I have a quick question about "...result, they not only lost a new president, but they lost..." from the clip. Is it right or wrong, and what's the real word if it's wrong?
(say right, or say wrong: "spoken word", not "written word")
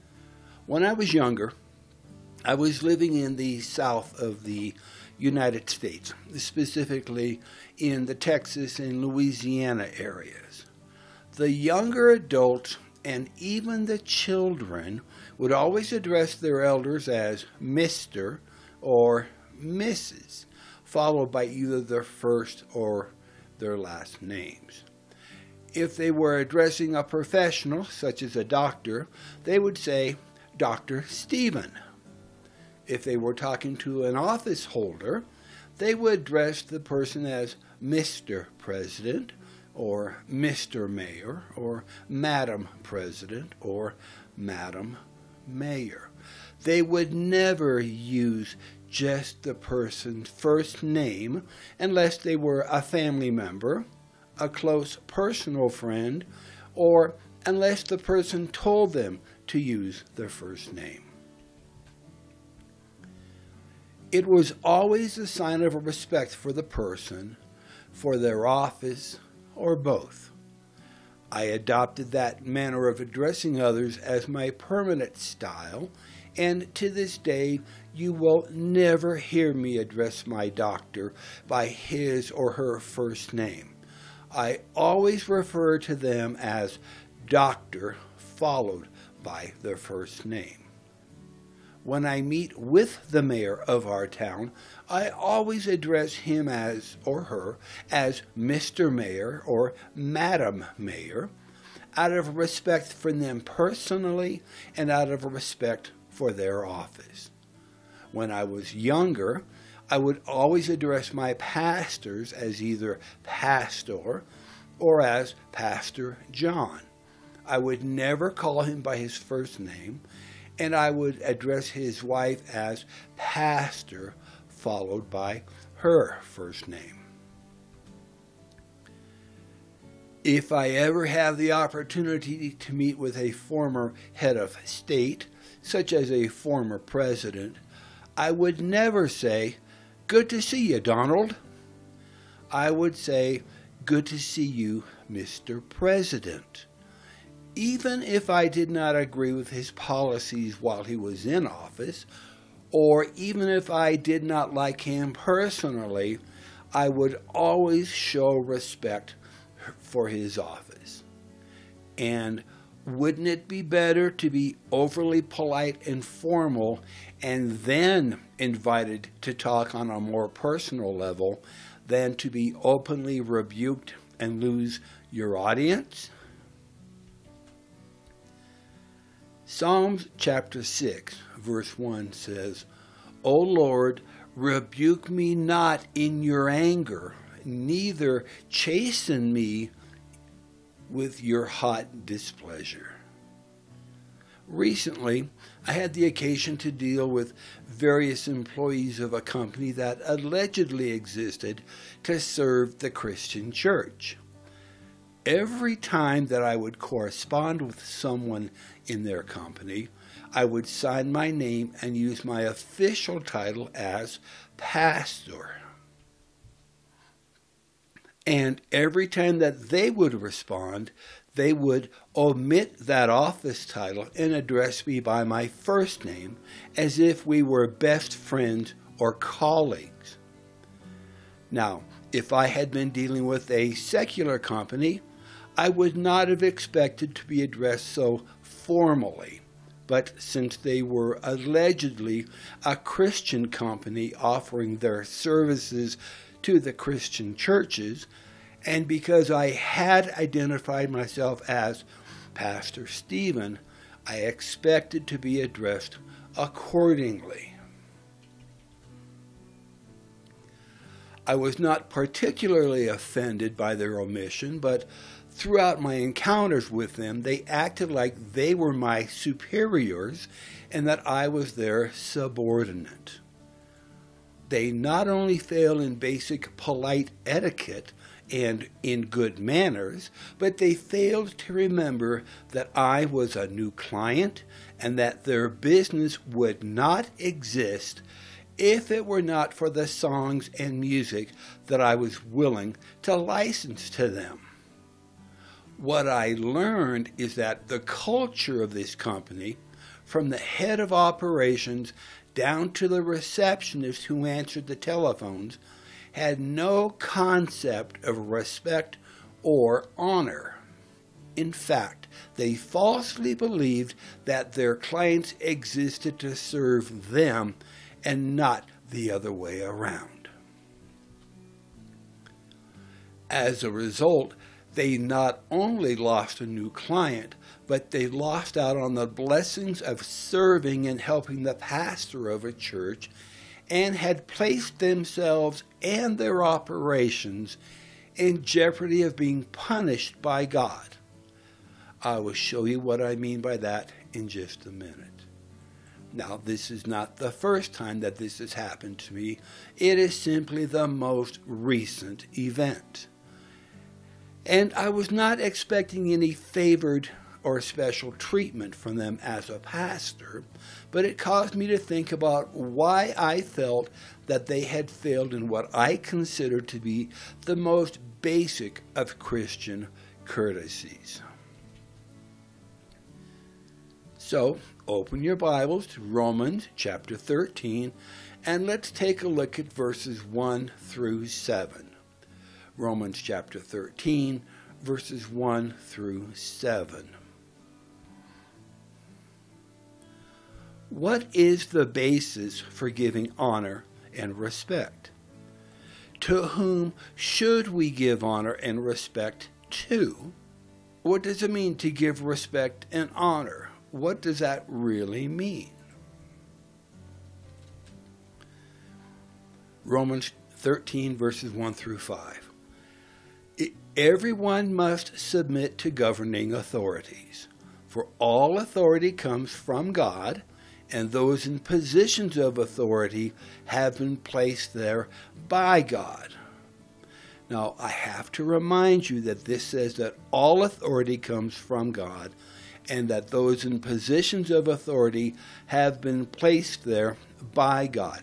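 wrong: "client", not "president".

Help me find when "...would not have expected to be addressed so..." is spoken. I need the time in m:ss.
3:55.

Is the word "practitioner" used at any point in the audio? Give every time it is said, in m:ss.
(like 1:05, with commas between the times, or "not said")
not said.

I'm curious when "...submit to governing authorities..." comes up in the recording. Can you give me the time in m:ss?
6:55.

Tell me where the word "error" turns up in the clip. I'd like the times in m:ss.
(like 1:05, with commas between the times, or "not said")
not said.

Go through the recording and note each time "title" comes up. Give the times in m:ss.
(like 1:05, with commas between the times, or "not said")
3:33, 3:43.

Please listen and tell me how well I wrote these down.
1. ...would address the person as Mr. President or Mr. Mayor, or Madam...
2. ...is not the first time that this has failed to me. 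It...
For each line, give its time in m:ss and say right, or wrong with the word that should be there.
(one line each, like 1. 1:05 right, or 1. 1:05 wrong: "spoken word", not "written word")
1. 0:35 right
2. 5:46 wrong: "happened", not "failed".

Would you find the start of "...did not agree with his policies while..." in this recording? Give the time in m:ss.
2:28.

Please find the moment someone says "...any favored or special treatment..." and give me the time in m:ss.
5:56.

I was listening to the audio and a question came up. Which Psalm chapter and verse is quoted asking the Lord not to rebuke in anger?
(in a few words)
Psalms 6:1.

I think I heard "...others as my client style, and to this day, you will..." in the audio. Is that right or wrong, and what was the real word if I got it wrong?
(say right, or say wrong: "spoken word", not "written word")
wrong: "permanent", not "client".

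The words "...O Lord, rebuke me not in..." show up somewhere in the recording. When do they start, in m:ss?
3:03.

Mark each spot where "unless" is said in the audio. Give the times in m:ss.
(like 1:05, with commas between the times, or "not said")
0:51, 0:57.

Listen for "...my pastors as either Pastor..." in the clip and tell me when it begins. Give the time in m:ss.
1:51.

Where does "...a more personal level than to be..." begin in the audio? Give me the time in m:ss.
2:49.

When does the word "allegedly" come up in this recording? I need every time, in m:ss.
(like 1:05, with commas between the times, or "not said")
3:20, 4:01.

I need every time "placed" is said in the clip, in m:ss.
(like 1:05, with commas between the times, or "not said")
5:34, 7:04, 7:16.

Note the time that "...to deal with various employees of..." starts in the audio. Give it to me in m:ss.
3:16.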